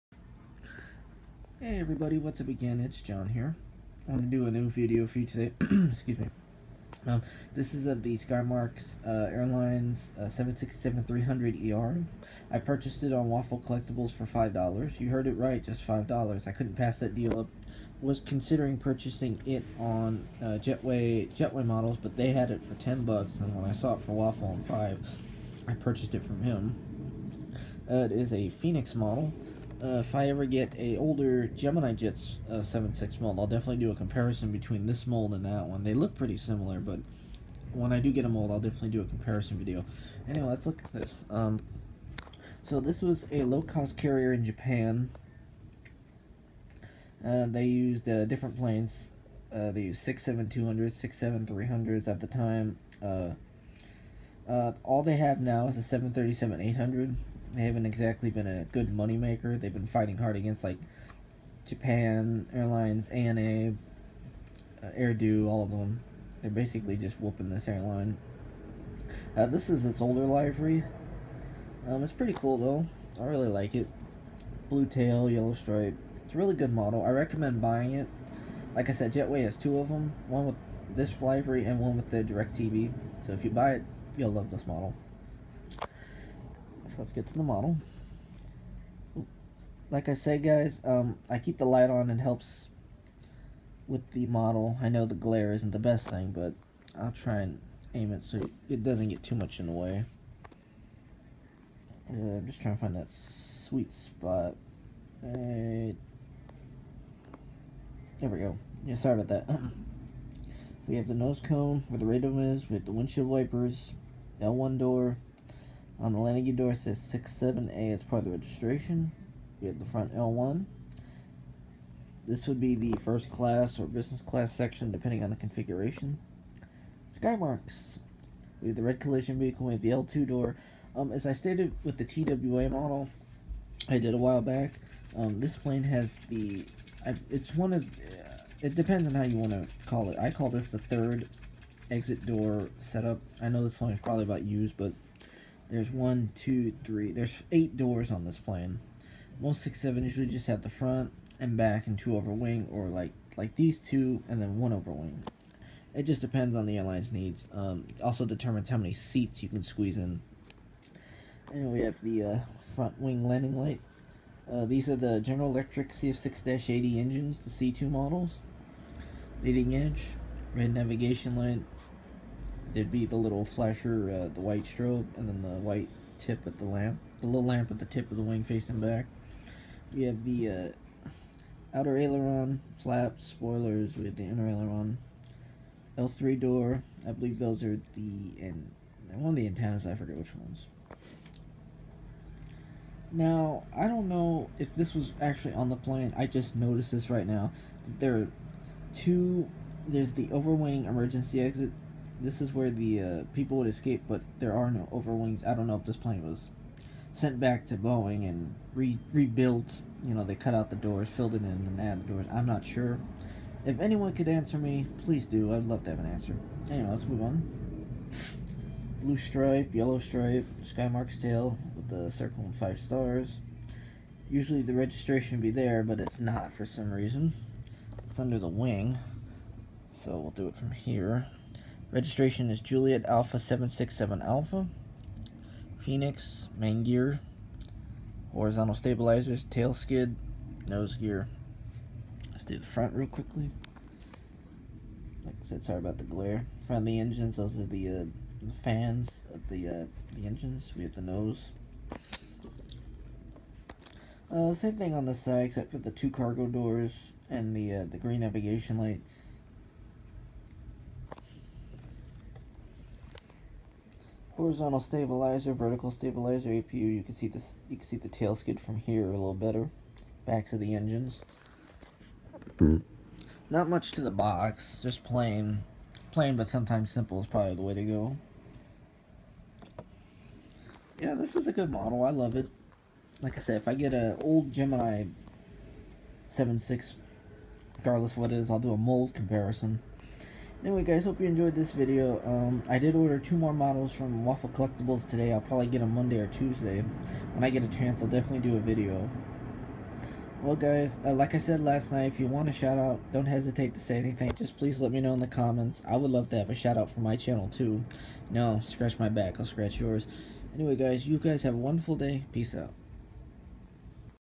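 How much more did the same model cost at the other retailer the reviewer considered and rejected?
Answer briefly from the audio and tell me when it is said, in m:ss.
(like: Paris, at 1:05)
10 bucks, at 0:22.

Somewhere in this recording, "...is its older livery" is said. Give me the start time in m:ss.
1:09.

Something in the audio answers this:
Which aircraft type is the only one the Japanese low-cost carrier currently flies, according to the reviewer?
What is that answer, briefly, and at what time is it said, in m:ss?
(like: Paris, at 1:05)
737-800, at 0:55.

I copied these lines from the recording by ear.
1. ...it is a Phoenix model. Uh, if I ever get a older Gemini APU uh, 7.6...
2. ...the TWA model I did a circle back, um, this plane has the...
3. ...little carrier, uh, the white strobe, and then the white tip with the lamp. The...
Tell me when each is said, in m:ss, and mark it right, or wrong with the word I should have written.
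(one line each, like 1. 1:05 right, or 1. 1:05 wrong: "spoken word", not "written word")
1. 0:28 wrong: "Jets", not "APU"
2. 2:11 wrong: "while", not "circle"
3. 2:53 wrong: "flasher", not "carrier".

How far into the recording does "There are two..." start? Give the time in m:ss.
3:17.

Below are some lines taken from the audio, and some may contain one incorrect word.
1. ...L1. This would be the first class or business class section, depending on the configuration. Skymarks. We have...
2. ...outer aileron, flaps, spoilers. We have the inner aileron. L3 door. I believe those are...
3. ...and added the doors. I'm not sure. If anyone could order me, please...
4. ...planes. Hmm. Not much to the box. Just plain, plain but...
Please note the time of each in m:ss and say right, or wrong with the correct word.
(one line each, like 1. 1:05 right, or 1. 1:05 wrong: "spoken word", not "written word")
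1. 2:00 right
2. 3:01 right
3. 3:31 wrong: "answer", not "order"
4. 4:30 wrong: "engines", not "planes".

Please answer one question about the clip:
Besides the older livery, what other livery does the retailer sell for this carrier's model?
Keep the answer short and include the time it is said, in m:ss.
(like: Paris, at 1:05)
DirecTV, at 1:22.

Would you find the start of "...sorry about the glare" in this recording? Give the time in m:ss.
4:05.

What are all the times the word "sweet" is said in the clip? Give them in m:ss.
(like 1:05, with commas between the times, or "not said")
1:43.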